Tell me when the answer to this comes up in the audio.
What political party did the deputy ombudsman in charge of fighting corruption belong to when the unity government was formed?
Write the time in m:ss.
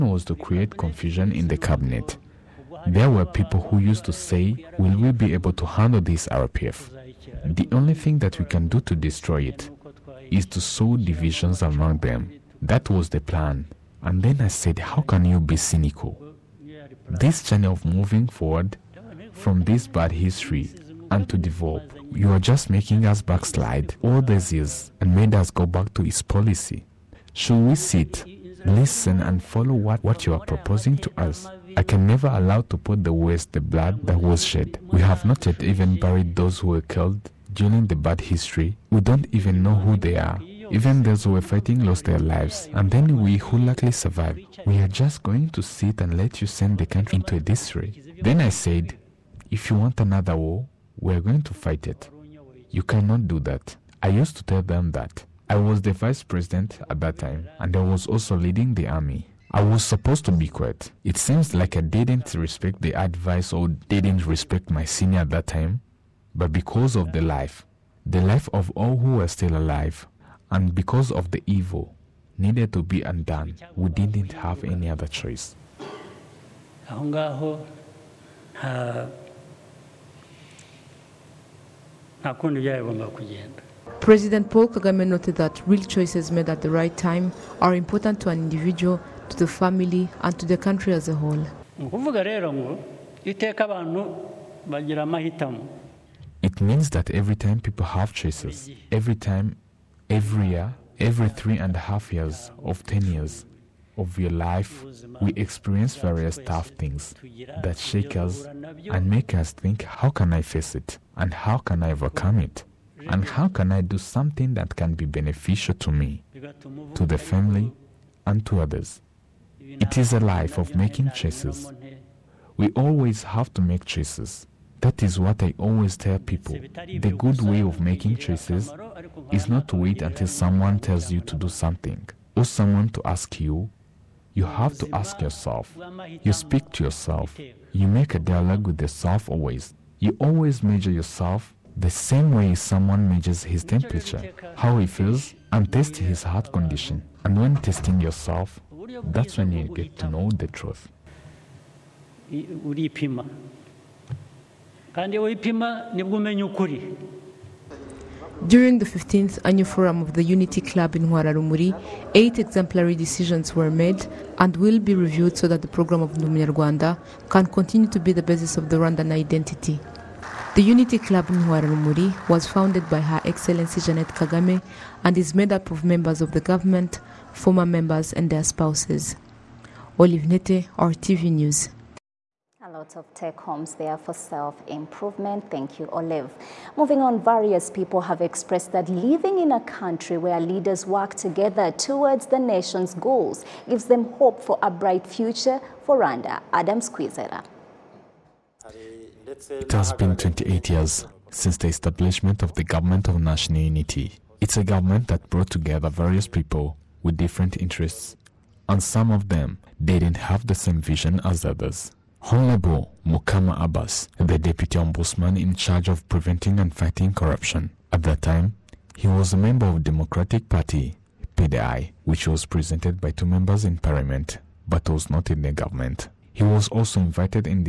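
3:39.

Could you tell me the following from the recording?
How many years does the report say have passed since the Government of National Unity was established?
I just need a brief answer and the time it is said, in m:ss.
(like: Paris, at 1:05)
28, at 3:20.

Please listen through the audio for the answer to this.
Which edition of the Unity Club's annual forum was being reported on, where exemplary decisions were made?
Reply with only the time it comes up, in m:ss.
2:38.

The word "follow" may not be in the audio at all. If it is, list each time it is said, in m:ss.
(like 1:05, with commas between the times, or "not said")
0:29.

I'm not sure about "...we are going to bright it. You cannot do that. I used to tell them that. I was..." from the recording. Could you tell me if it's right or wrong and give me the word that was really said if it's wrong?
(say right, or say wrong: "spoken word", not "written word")
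wrong: "fight", not "bright".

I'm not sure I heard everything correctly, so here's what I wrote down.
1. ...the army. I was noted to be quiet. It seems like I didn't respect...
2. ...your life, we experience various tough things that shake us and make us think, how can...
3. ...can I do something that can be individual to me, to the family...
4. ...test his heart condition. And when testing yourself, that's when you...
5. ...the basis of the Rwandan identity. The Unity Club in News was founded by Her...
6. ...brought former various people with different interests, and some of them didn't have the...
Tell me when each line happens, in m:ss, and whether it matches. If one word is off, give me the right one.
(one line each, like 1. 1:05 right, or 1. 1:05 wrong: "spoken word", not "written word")
1. 0:58 wrong: "supposed", not "noted"
2. 1:44 right
3. 1:53 wrong: "beneficial", not "individual"
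4. 2:25 right
5. 2:48 wrong: "Huararumuri", not "News"
6. 3:25 wrong: "together", not "former".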